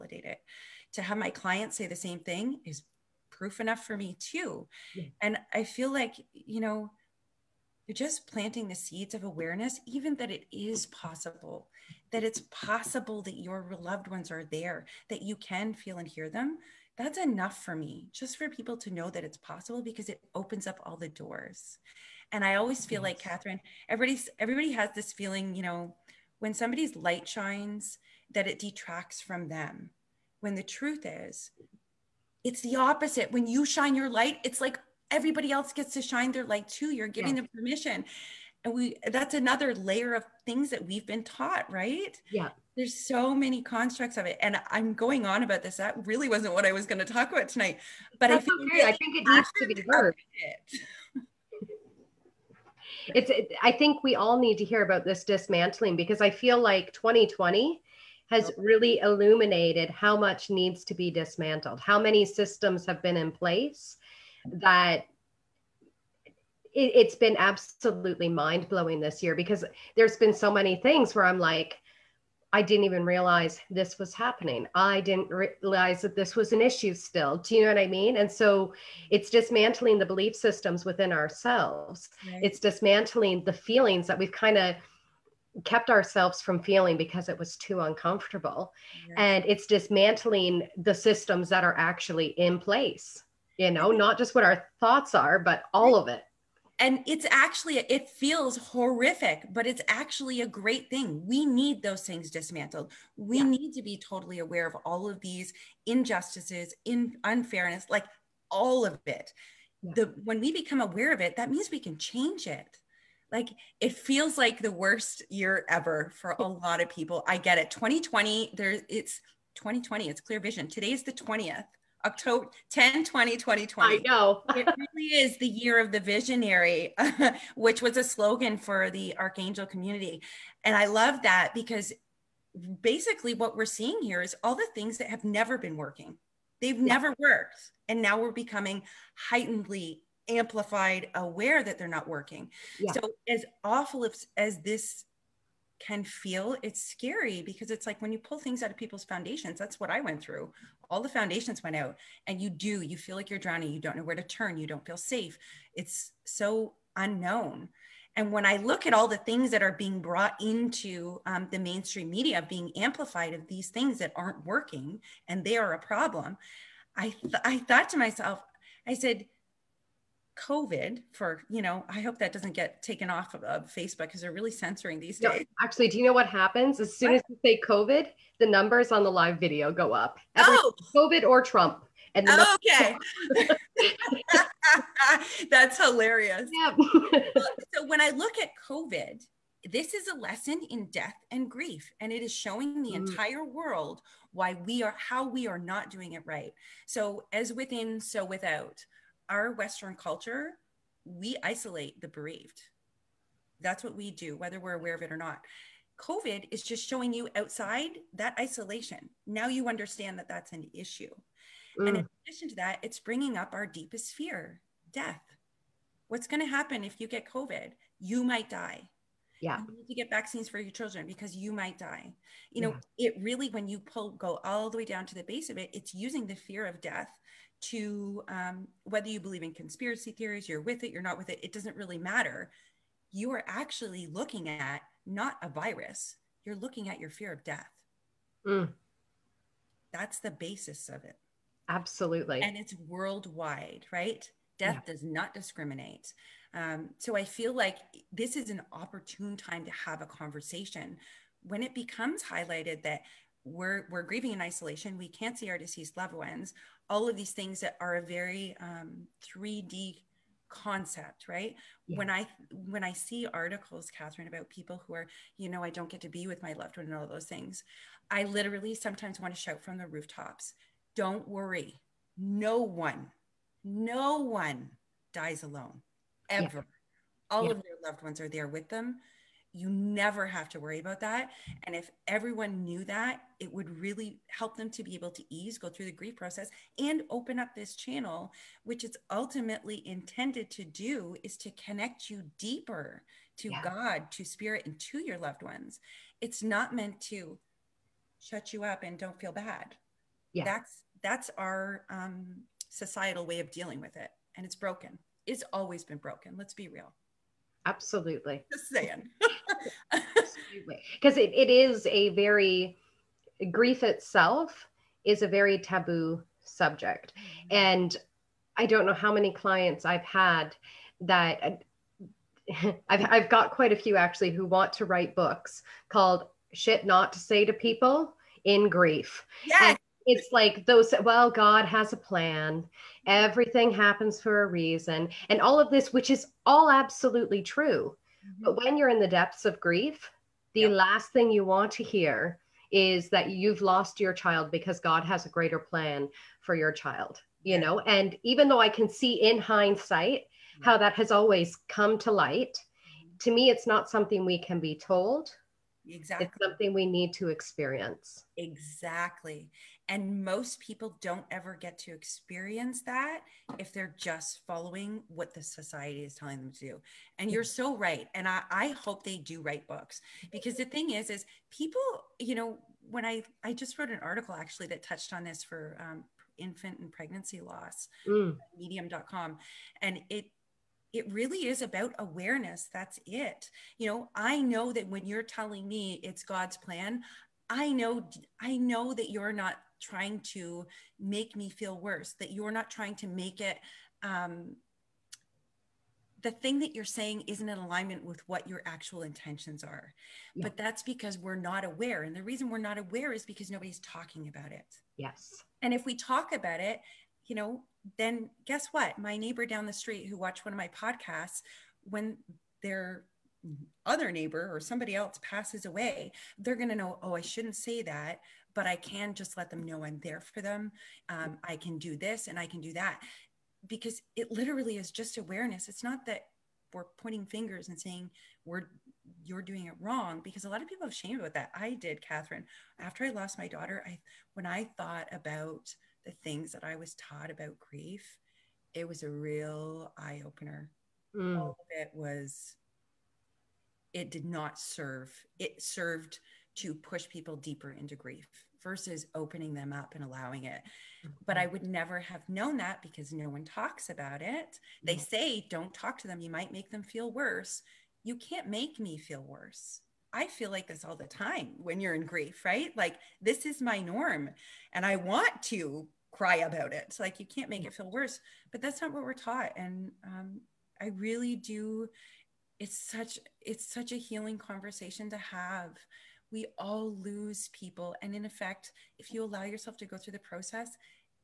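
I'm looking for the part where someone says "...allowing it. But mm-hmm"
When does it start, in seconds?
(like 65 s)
450 s.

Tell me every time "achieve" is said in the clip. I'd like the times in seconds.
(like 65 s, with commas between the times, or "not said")
not said.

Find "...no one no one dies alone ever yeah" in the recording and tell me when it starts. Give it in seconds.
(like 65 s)
272 s.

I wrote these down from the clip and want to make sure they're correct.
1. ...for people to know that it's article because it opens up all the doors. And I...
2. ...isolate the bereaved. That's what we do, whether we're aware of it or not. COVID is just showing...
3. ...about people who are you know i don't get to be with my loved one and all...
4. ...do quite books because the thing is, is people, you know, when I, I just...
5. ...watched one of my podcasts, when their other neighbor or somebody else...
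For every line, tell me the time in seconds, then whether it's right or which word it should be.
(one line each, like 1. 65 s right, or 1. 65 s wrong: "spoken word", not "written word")
1. 18 s wrong: "possible", not "article"
2. 201 s right
3. 264 s right
4. 369 s wrong: "write", not "quite"
5. 410 s right.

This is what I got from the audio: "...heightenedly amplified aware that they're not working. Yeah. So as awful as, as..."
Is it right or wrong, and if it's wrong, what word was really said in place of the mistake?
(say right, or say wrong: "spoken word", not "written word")
right.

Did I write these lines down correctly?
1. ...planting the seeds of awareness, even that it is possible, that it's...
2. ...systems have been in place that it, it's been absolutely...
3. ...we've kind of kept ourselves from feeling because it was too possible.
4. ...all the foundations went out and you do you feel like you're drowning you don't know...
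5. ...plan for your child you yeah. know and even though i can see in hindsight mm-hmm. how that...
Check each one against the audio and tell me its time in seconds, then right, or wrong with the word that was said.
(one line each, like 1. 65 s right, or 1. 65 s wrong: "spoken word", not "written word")
1. 8 s right
2. 62 s right
3. 84 s wrong: "uncomfortable", not "possible"
4. 150 s right
5. 345 s right.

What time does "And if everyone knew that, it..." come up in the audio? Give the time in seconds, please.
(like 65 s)
281 s.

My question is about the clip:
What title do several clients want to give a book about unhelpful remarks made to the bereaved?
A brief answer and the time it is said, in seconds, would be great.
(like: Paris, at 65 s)
Shit Not to Say to People in Grief, at 326 s.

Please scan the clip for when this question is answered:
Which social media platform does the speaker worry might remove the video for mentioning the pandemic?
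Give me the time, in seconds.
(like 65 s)
173 s.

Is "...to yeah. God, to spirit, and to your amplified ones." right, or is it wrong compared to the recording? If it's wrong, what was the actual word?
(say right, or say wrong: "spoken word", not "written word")
wrong: "loved", not "amplified".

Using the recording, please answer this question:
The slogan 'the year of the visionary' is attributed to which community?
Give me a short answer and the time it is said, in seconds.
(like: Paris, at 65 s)
Archangel community, at 129 s.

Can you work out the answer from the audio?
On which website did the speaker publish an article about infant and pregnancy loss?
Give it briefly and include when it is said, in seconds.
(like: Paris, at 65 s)
medium.com, at 378 s.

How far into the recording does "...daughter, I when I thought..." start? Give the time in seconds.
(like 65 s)
433 s.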